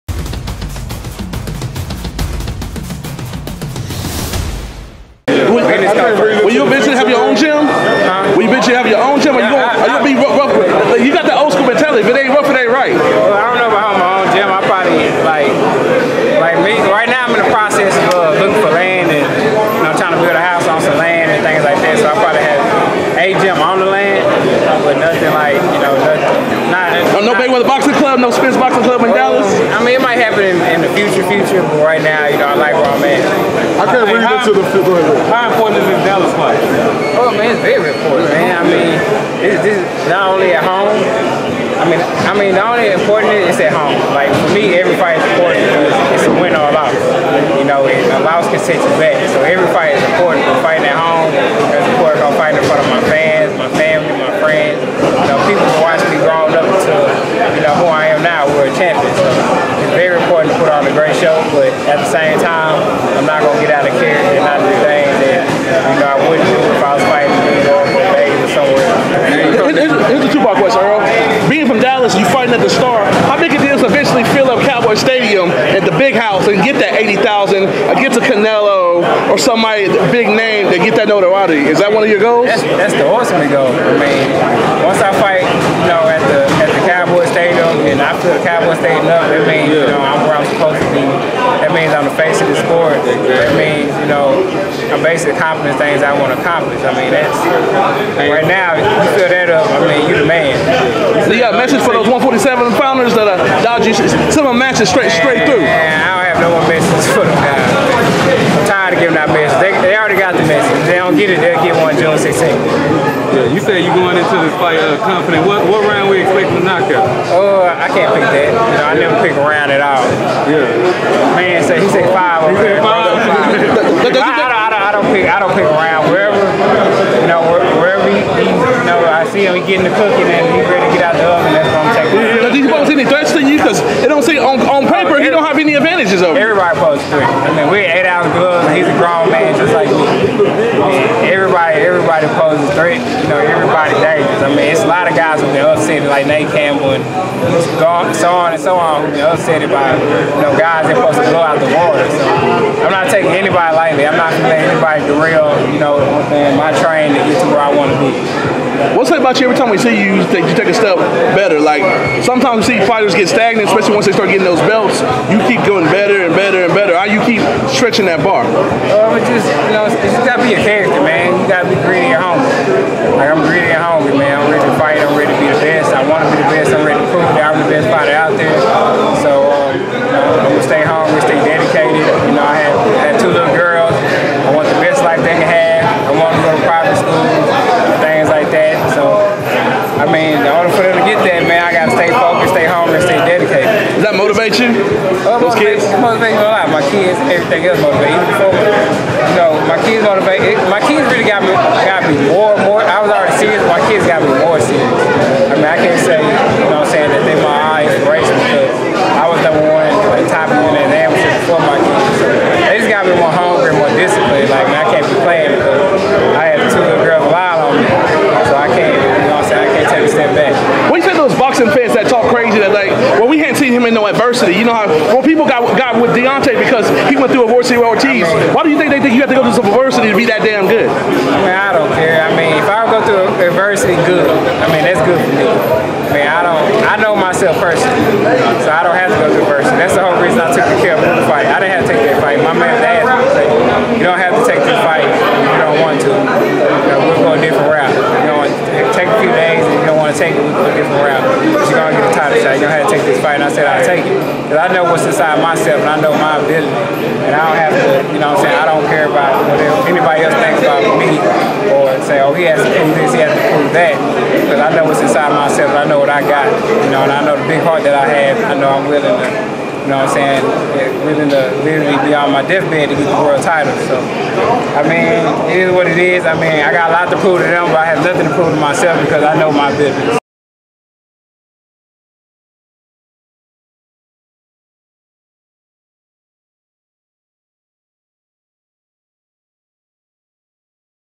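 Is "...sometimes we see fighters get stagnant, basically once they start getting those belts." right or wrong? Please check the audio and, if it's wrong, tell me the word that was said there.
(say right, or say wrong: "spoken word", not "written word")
wrong: "especially", not "basically".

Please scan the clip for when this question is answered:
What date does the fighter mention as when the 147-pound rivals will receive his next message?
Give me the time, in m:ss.
1:51.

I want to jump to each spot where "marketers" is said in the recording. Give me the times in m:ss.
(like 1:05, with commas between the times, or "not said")
not said.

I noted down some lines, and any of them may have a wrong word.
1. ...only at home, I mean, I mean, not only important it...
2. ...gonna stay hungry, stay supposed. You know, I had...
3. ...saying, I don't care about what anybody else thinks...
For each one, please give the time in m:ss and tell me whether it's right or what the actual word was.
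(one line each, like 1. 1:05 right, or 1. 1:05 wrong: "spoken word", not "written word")
1. 0:40 right
2. 3:00 wrong: "dedicated", not "supposed"
3. 4:18 right.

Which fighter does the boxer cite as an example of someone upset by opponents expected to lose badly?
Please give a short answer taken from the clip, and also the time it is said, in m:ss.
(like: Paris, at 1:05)
Nate Campbell, at 2:26.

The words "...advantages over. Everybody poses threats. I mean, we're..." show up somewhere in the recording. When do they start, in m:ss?
2:15.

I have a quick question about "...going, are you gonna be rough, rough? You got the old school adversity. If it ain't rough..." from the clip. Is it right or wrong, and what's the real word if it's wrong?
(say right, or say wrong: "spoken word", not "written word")
wrong: "mentality", not "adversity".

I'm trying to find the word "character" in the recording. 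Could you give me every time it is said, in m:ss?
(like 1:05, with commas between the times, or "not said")
1:03, 2:50.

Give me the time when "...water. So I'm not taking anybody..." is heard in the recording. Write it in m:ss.
2:31.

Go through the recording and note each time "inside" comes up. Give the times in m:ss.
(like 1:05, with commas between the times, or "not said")
4:15, 4:25.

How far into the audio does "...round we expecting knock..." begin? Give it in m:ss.
1:55.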